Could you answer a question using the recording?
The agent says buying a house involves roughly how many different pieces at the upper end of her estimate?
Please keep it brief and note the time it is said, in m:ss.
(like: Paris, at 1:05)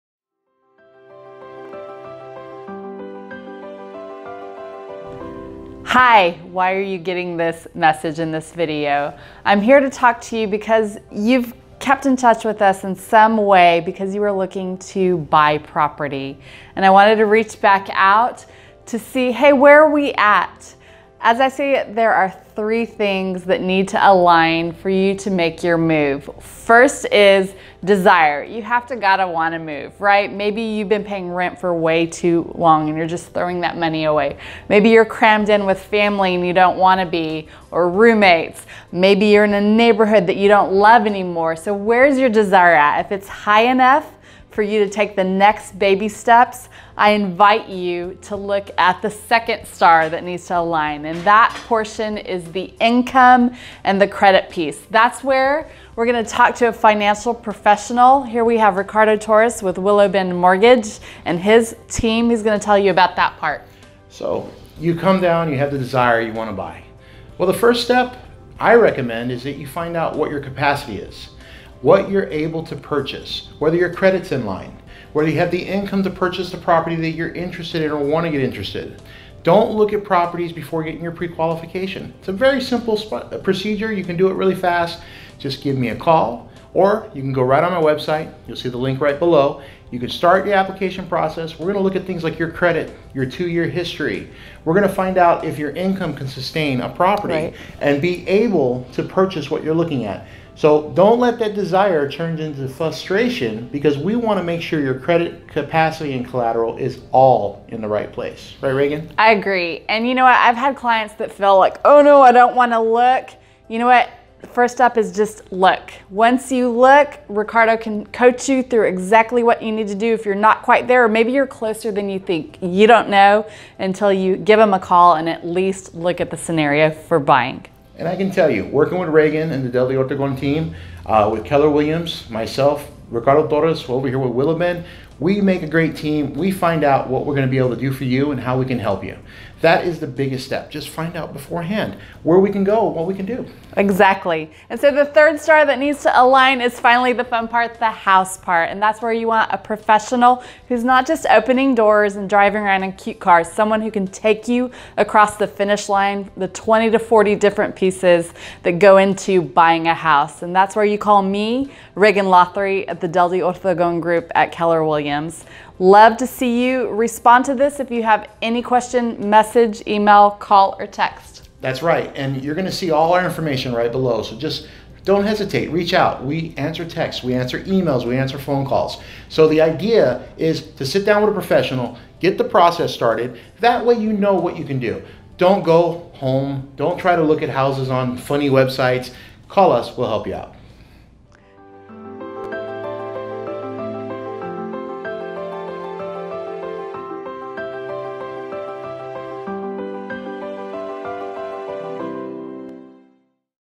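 40, at 2:36.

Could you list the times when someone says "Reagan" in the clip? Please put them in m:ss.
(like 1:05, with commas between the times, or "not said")
1:48, 2:09.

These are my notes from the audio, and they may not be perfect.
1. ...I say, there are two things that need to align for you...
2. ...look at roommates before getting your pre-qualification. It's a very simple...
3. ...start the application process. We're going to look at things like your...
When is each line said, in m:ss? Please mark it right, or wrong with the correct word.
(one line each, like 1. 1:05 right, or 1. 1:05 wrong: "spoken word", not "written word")
1. 0:21 wrong: "three", not "two"
2. 1:19 wrong: "properties", not "roommates"
3. 1:30 right.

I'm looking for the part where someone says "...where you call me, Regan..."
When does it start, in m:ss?
2:40.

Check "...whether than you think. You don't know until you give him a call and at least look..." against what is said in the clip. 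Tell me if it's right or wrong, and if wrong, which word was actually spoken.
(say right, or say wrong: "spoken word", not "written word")
wrong: "closer", not "whether".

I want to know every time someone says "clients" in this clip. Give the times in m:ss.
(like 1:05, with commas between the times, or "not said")
1:50.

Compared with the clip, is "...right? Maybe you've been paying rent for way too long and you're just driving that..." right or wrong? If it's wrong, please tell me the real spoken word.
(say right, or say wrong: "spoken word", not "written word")
wrong: "throwing", not "driving".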